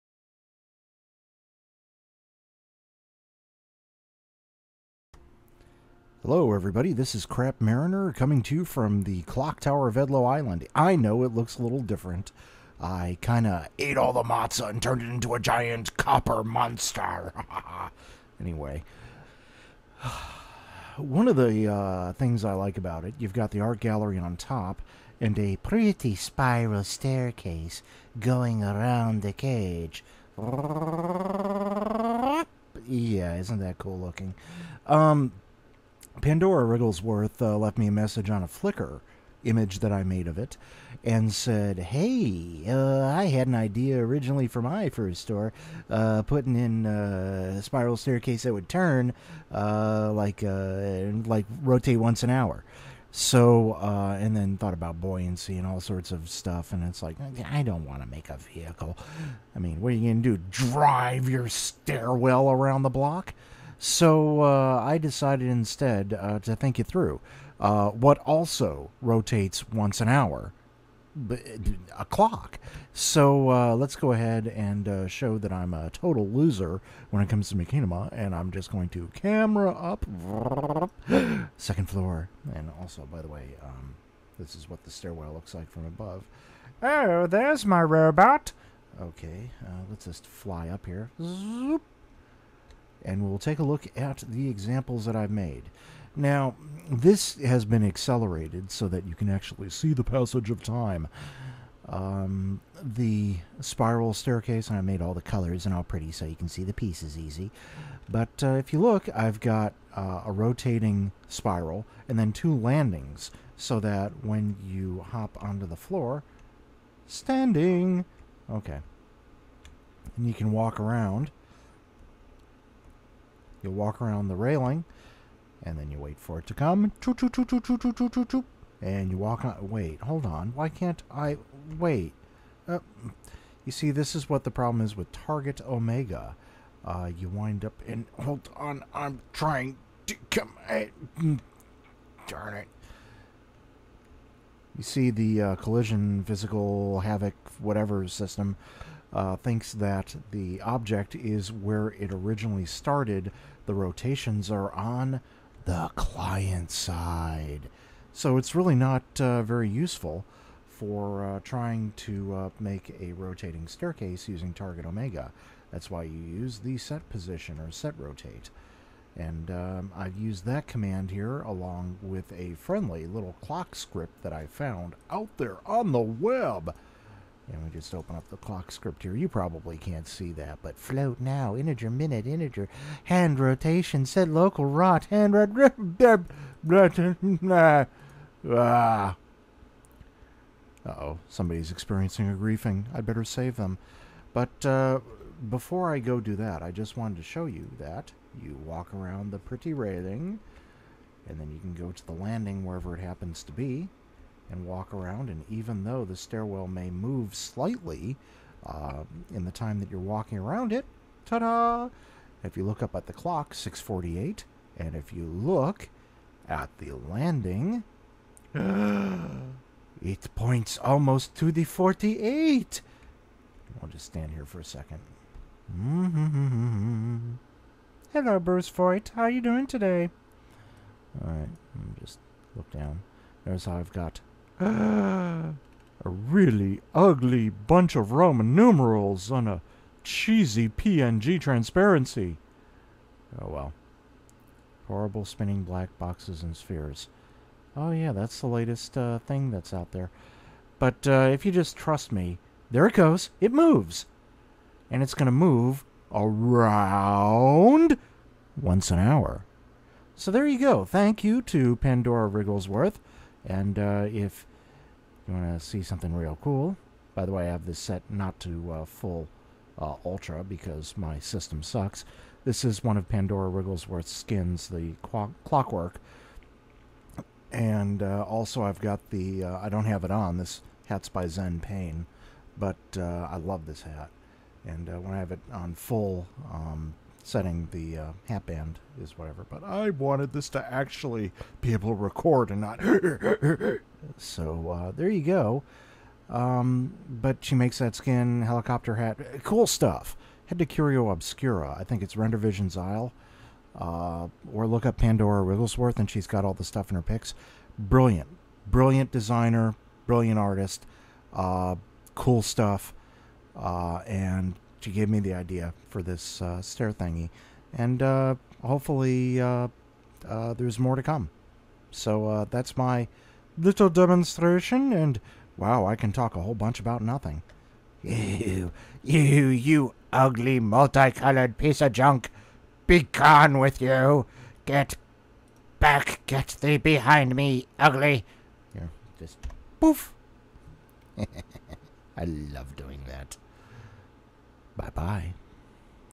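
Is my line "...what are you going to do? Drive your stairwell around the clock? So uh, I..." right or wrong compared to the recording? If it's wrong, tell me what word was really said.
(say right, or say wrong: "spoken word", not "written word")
wrong: "block", not "clock".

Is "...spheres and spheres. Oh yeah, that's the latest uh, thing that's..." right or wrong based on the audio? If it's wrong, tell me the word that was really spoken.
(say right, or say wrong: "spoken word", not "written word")
wrong: "boxes", not "spheres".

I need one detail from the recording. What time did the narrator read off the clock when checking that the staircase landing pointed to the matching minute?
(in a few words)
6:48.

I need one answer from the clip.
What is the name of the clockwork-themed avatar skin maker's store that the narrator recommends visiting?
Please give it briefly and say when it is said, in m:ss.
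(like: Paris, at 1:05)
Curio Obscura, at 5:00.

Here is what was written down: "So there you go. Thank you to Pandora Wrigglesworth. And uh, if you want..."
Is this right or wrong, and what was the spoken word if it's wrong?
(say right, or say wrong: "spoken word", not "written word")
right.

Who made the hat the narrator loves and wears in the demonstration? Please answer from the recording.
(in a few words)
Zen Payne.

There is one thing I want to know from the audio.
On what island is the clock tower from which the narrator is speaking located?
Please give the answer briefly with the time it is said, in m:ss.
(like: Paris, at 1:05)
Edlow Island, at 0:09.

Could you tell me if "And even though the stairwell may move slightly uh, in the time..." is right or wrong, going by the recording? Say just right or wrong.
right.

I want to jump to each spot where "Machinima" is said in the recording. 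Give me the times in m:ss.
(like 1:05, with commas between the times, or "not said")
1:17.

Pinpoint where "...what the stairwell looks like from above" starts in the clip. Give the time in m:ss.
1:24.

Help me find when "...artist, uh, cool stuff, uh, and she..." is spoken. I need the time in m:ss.
5:10.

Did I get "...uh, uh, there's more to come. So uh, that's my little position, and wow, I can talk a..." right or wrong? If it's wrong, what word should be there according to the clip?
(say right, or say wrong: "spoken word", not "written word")
wrong: "demonstration", not "position".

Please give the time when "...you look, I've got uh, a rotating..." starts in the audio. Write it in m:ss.
1:48.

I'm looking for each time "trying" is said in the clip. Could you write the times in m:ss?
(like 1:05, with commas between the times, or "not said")
2:19, 2:41.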